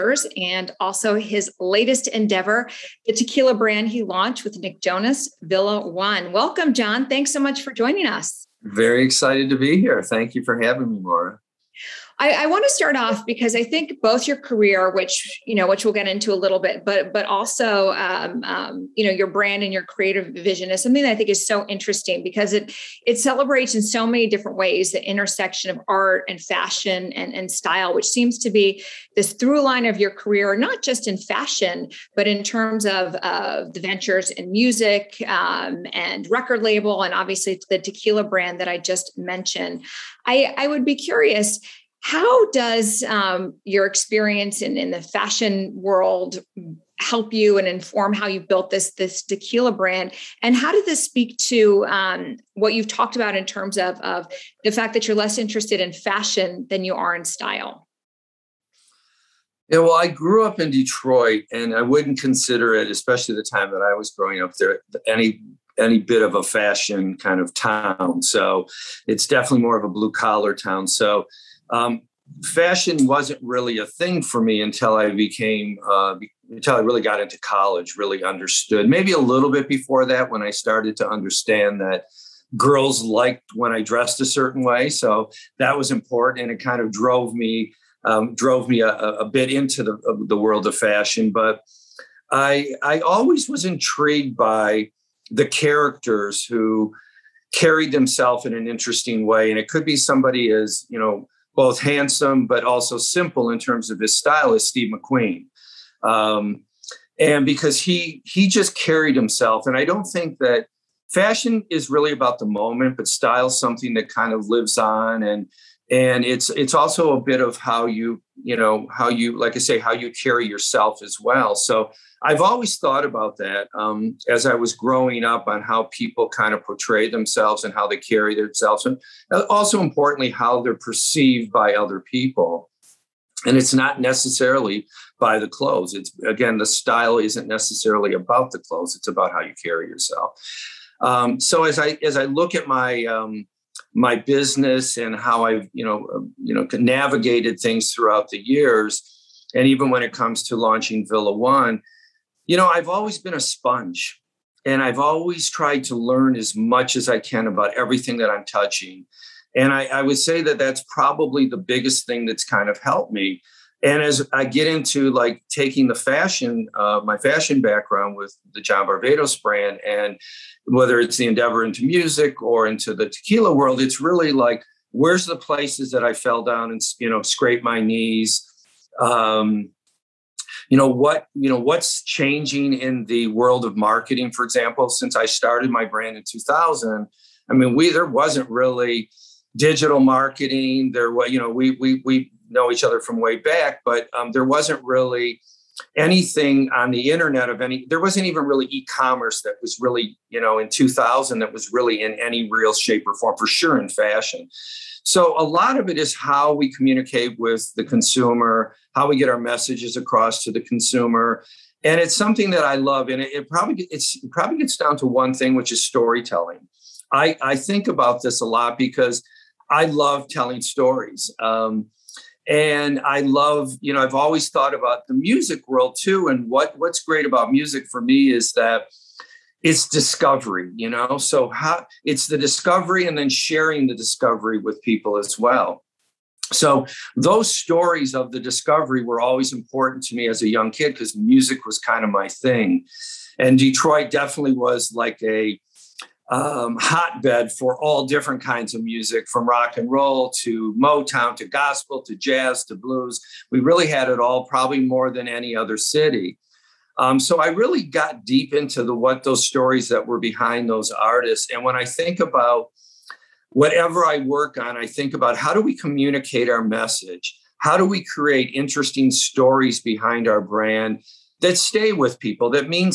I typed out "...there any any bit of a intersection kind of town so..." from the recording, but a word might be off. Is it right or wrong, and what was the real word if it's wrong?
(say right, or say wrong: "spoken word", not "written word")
wrong: "fashion", not "intersection".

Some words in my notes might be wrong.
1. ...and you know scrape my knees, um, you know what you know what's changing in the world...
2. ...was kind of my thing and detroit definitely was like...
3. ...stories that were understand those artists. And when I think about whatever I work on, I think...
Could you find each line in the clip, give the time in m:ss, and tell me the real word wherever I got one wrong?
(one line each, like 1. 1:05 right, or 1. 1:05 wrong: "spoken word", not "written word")
1. 2:56 right
2. 4:01 right
3. 4:19 wrong: "behind", not "understand".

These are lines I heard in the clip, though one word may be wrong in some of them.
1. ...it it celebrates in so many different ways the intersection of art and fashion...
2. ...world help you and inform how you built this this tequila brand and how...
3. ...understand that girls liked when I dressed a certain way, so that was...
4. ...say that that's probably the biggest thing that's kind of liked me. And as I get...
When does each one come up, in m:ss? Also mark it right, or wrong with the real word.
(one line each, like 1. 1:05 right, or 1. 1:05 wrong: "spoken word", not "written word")
1. 0:22 right
2. 0:45 right
3. 1:21 right
4. 2:40 wrong: "helped", not "liked".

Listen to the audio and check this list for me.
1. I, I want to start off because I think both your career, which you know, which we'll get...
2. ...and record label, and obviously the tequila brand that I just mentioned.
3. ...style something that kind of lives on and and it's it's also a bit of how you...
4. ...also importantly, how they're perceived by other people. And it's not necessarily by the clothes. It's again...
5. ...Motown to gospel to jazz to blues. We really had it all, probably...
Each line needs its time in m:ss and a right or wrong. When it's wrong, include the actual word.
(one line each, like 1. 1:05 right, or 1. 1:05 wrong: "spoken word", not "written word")
1. 0:12 right
2. 0:35 right
3. 1:53 right
4. 2:09 right
5. 4:10 right.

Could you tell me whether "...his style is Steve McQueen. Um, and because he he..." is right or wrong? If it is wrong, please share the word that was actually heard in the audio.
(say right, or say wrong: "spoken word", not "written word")
right.